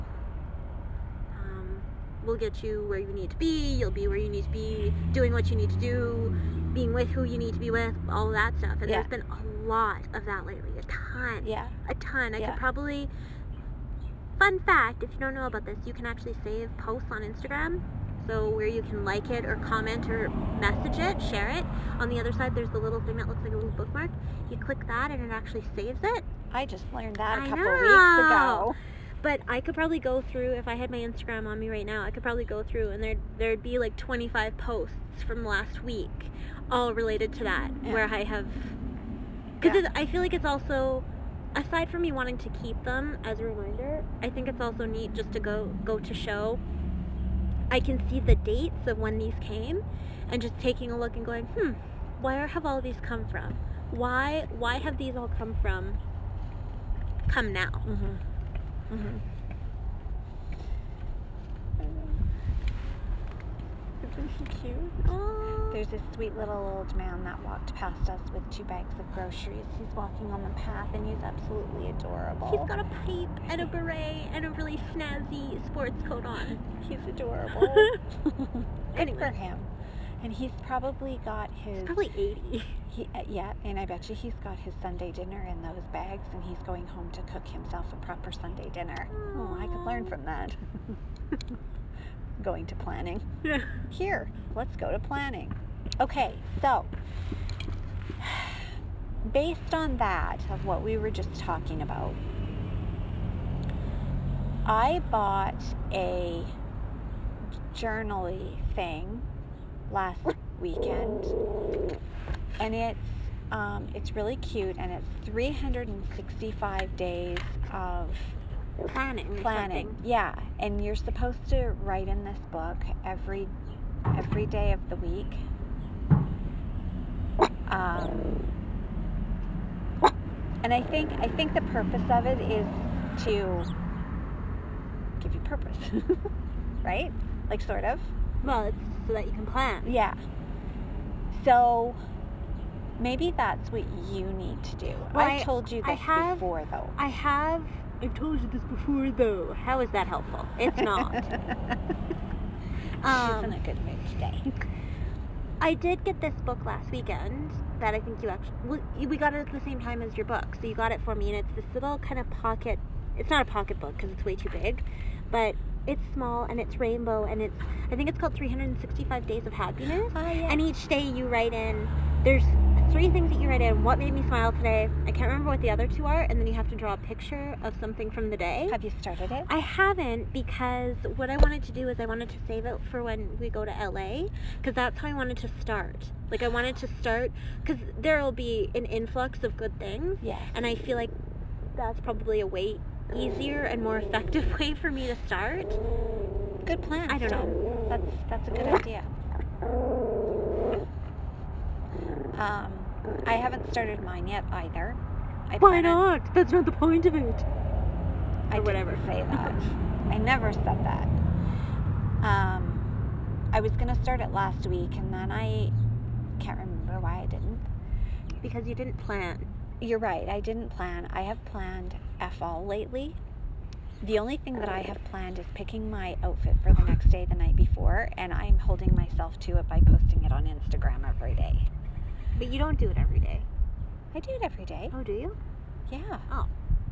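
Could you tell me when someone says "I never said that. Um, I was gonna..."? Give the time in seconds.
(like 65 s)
210 s.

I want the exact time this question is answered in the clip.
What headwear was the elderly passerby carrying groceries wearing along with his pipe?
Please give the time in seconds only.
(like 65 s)
73 s.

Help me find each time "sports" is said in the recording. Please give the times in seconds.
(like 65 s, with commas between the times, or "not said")
75 s.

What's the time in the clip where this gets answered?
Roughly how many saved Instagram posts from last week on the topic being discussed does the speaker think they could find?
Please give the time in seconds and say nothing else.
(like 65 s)
33 s.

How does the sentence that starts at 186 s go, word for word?
Like I wanted to start because there'll be an influx of good things.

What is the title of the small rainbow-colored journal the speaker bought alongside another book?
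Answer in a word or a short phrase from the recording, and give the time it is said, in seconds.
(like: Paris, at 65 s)
365 Days of Happiness, at 168 s.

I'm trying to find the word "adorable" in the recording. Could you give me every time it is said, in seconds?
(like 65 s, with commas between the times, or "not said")
71 s, 77 s.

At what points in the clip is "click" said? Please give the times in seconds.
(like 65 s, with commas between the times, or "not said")
24 s.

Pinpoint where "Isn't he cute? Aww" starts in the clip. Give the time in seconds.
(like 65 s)
64 s.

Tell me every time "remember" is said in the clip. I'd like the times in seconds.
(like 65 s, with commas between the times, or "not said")
175 s, 216 s.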